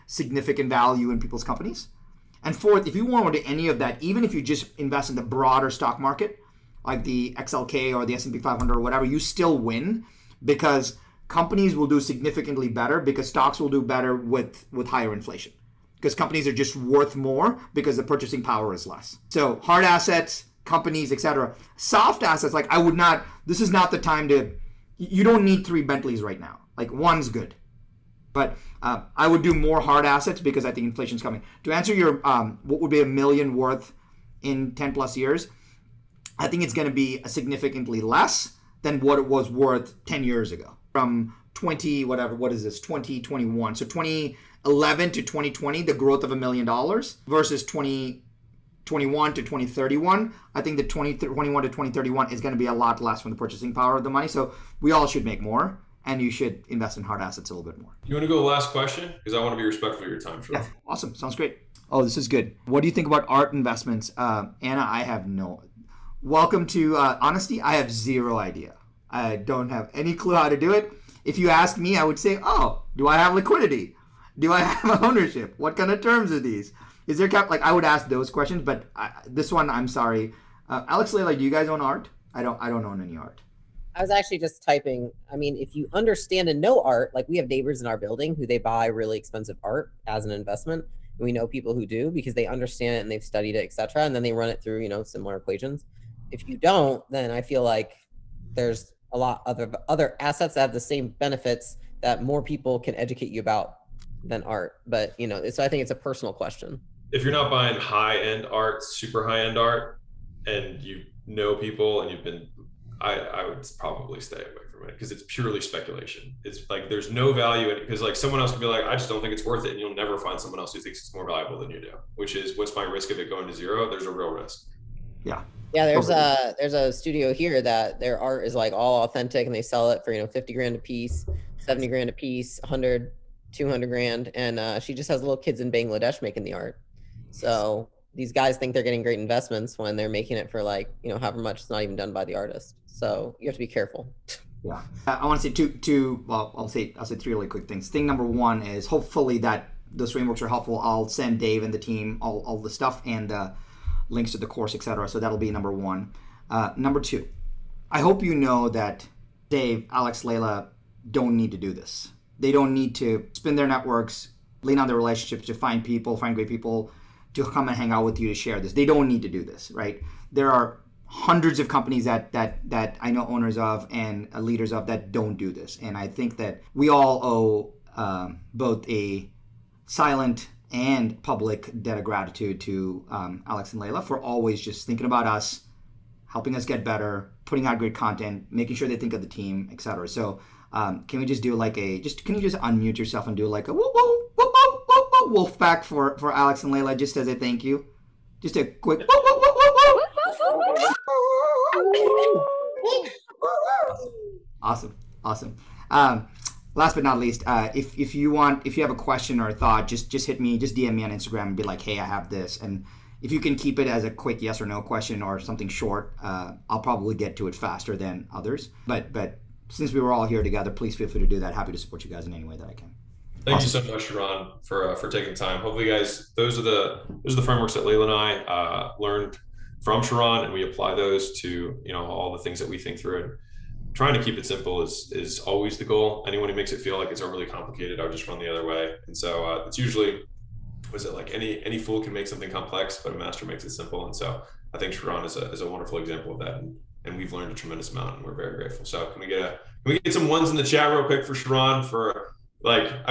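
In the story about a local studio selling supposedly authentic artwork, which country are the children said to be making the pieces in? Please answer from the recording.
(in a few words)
Bangladesh.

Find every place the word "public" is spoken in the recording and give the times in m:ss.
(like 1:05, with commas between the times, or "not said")
3:01.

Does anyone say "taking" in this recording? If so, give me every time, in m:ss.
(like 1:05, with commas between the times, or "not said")
3:45.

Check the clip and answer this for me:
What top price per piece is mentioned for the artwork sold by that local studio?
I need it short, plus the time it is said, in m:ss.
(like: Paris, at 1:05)
200 grand, at 2:13.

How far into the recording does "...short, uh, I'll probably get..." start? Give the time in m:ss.
3:35.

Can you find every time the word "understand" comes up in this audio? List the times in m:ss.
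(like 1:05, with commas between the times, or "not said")
1:25, 1:32.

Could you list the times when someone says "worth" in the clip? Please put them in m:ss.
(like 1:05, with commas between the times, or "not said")
0:16, 0:33, 0:39, 1:59.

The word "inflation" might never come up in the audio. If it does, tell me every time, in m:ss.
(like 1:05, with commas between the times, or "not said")
0:15, 0:30.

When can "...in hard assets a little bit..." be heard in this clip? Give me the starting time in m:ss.
0:56.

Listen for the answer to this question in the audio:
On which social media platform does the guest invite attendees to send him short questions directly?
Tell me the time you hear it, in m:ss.
3:31.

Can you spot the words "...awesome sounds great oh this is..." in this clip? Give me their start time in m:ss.
1:00.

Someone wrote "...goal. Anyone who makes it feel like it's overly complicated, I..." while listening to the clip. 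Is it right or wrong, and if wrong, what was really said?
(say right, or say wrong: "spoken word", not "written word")
right.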